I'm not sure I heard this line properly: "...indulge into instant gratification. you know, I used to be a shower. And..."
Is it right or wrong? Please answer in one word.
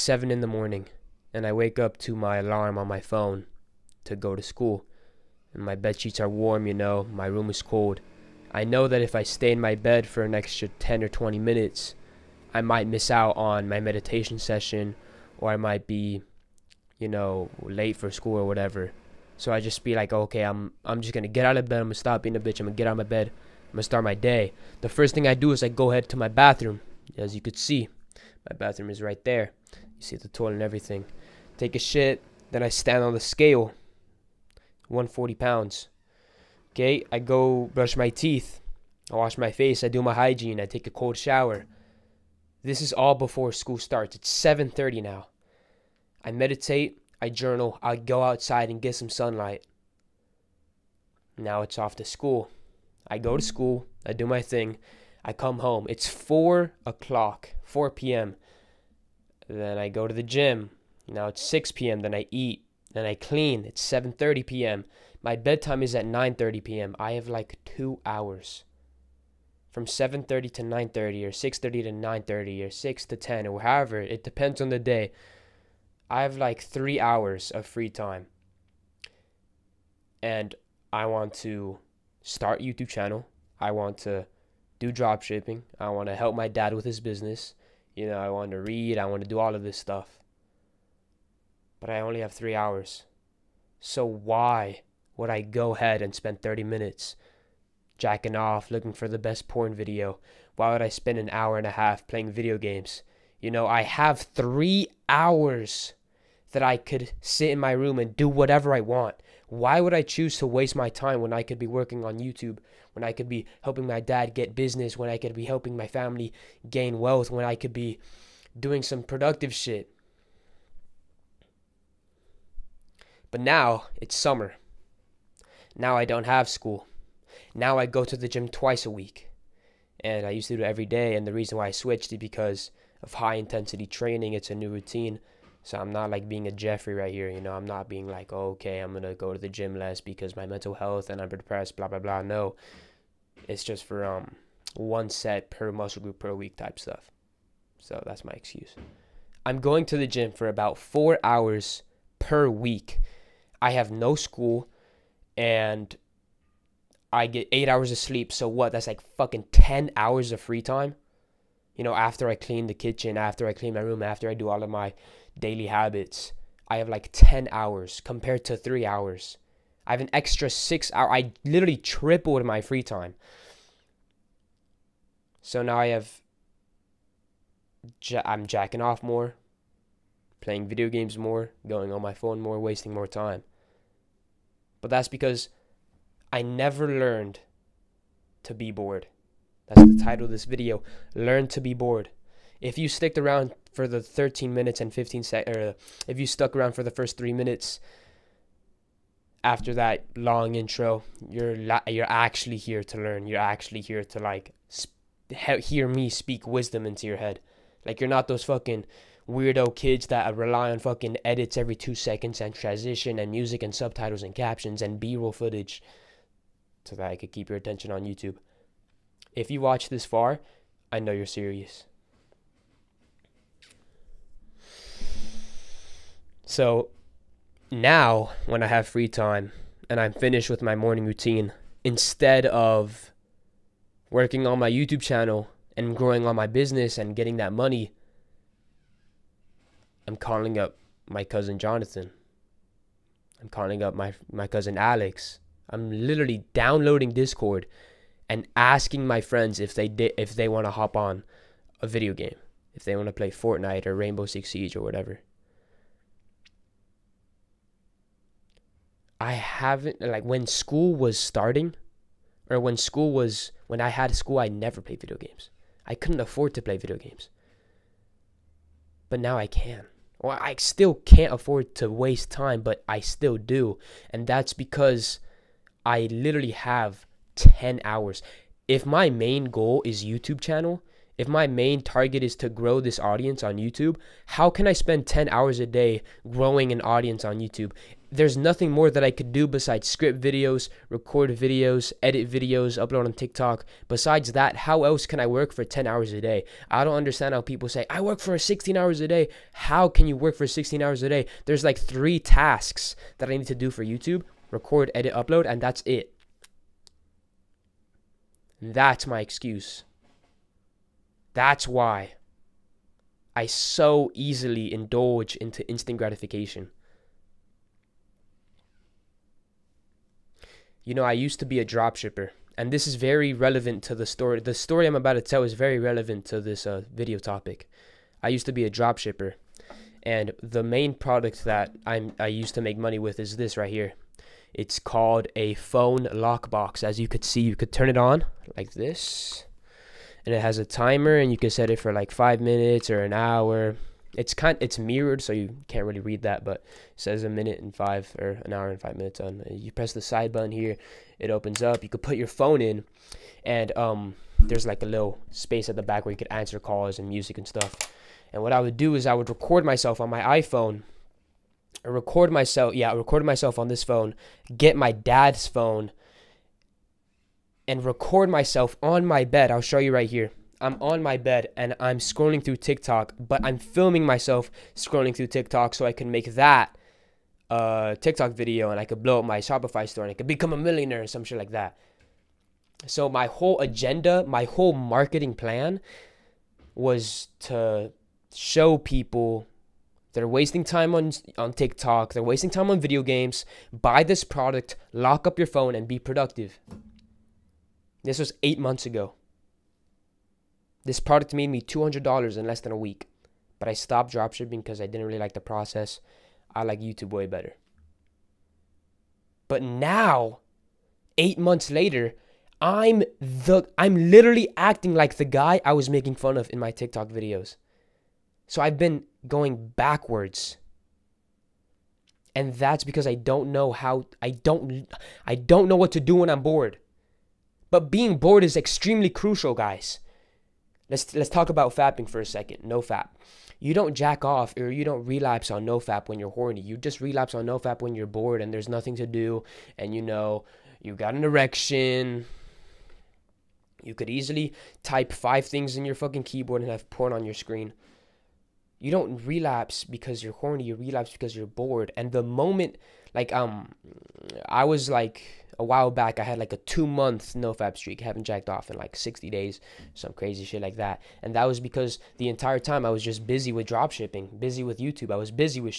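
wrong.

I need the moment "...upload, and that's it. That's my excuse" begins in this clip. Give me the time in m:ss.
5:05.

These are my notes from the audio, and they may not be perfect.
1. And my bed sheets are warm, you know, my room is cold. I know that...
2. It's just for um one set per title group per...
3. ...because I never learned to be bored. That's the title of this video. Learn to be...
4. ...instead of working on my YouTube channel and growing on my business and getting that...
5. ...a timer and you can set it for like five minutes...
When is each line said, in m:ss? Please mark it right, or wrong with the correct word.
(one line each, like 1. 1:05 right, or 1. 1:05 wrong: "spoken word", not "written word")
1. 0:05 right
2. 2:23 wrong: "muscle", not "title"
3. 3:05 right
4. 3:51 right
5. 5:40 right.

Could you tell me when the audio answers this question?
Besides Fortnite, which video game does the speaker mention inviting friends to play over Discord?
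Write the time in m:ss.
4:13.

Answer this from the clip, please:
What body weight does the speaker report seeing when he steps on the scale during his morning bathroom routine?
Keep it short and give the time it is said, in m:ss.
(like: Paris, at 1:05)
140 pounds, at 0:34.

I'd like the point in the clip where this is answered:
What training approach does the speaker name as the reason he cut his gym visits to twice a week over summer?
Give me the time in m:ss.
2:13.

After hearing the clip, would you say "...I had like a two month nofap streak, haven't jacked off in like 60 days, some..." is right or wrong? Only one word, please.
right.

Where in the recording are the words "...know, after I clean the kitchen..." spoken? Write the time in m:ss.
2:41.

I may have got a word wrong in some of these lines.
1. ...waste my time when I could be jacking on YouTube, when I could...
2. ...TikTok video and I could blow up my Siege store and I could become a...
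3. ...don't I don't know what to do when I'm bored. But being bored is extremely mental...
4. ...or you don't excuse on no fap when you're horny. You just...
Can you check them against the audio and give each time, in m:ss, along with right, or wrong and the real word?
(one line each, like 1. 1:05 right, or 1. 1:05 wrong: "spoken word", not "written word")
1. 1:50 wrong: "working", not "jacking"
2. 6:17 wrong: "Shopify", not "Siege"
3. 7:04 wrong: "crucial", not "mental"
4. 7:14 wrong: "relapse", not "excuse".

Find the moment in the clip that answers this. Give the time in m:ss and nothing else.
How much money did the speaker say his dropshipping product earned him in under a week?
6:41.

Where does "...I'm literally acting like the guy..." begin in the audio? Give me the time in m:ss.
6:53.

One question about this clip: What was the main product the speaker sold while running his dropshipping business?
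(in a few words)
phone lockbox.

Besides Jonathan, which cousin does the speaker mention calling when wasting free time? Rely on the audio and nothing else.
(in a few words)
Alex.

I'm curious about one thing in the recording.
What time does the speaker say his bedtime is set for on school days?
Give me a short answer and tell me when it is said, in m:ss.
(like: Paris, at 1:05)
9:30 p.m., at 1:06.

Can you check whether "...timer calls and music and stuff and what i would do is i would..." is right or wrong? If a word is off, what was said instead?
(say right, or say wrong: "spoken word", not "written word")
wrong: "answer", not "timer".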